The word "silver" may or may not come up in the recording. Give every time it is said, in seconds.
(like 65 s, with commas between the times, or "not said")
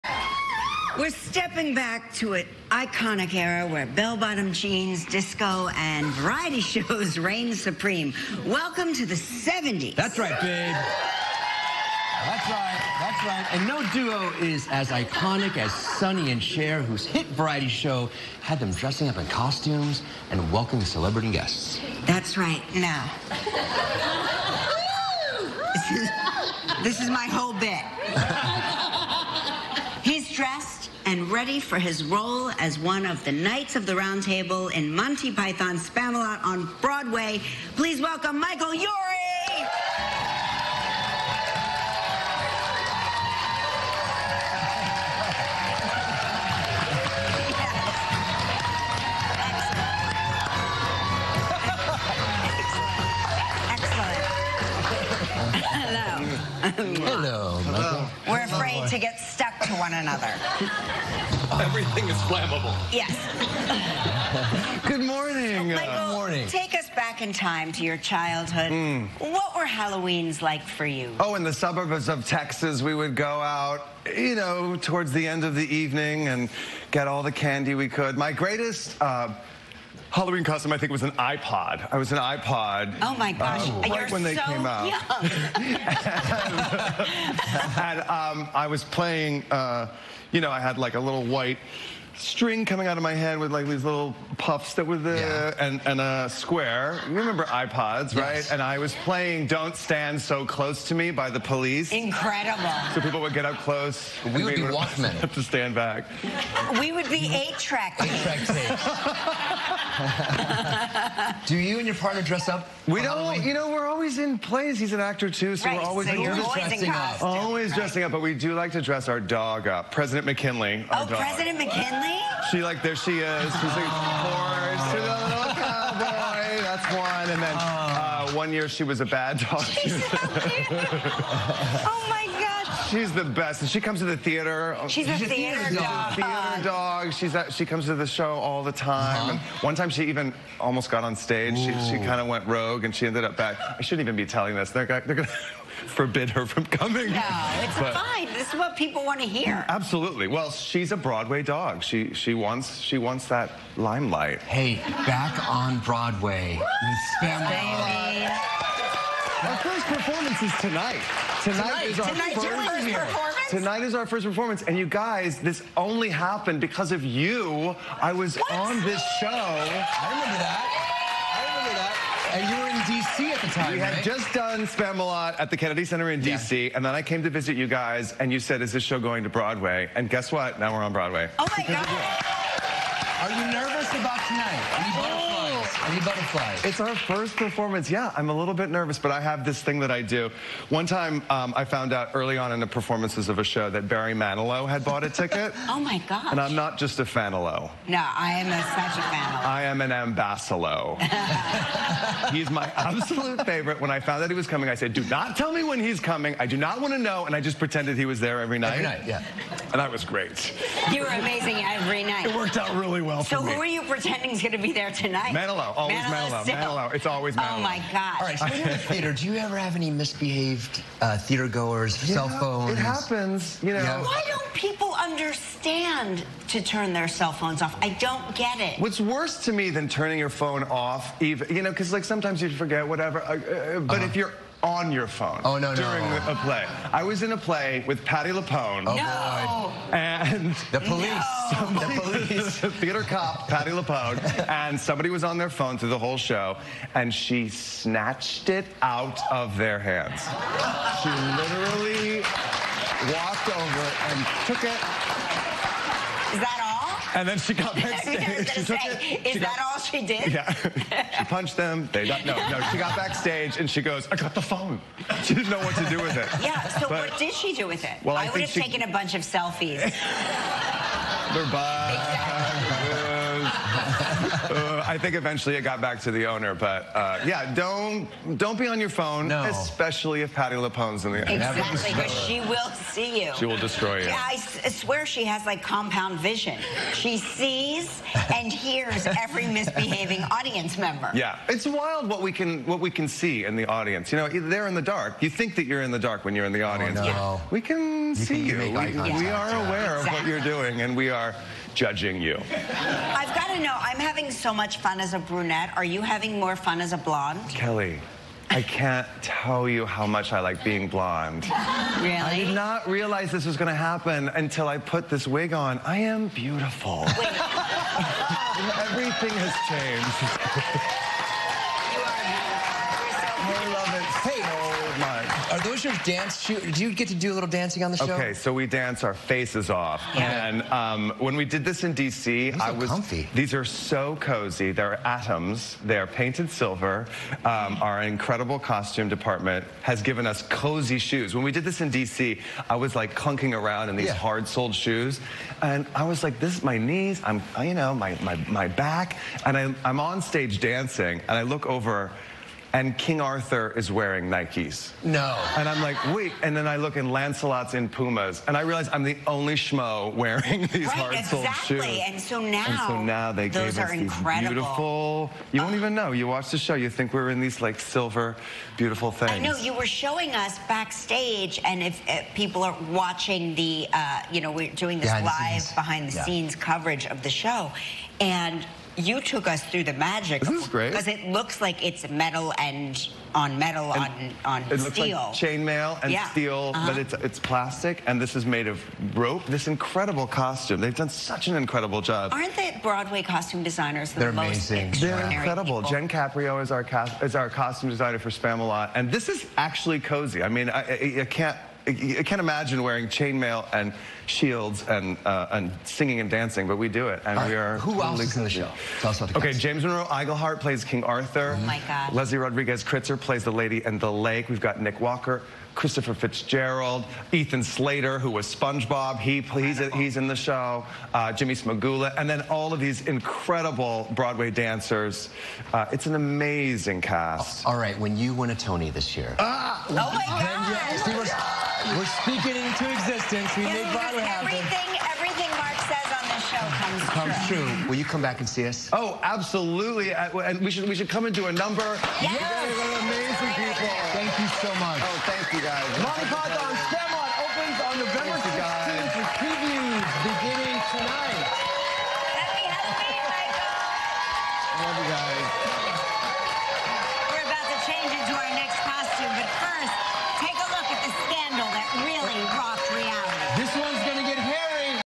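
336 s, 367 s.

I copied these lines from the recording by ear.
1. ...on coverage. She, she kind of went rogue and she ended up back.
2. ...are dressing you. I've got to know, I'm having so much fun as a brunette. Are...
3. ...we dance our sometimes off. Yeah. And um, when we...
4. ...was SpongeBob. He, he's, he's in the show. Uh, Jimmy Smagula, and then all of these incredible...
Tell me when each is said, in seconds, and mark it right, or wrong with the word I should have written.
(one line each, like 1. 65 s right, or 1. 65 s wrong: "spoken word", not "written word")
1. 141 s wrong: "stage", not "coverage"
2. 301 s wrong: "judging", not "dressing"
3. 328 s wrong: "faces", not "sometimes"
4. 418 s right.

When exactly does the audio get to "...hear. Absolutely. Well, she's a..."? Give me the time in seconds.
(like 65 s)
149 s.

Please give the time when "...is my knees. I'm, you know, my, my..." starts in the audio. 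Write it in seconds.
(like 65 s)
346 s.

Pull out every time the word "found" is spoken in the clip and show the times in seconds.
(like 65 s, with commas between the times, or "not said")
191 s, 203 s.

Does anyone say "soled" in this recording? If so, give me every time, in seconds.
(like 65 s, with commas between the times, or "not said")
344 s, 361 s.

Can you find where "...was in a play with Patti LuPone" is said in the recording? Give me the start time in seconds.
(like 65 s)
237 s.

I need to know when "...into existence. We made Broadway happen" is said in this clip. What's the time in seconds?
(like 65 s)
432 s.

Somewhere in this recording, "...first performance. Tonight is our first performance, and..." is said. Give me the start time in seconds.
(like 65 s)
162 s.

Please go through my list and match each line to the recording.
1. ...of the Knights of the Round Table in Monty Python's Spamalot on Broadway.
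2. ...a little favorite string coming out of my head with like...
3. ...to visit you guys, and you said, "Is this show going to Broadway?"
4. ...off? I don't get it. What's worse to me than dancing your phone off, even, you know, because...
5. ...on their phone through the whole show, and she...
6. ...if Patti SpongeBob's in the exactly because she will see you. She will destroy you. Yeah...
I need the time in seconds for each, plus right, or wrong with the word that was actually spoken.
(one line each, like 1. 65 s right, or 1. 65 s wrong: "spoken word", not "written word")
1. 33 s right
2. 90 s wrong: "white", not "favorite"
3. 177 s right
4. 227 s wrong: "turning", not "dancing"
5. 245 s right
6. 280 s wrong: "LuPone", not "SpongeBob".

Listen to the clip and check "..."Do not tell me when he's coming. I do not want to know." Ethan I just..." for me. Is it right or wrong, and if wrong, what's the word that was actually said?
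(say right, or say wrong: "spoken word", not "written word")
wrong: "And", not "Ethan".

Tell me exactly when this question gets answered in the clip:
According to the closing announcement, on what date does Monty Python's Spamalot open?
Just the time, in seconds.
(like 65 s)
448 s.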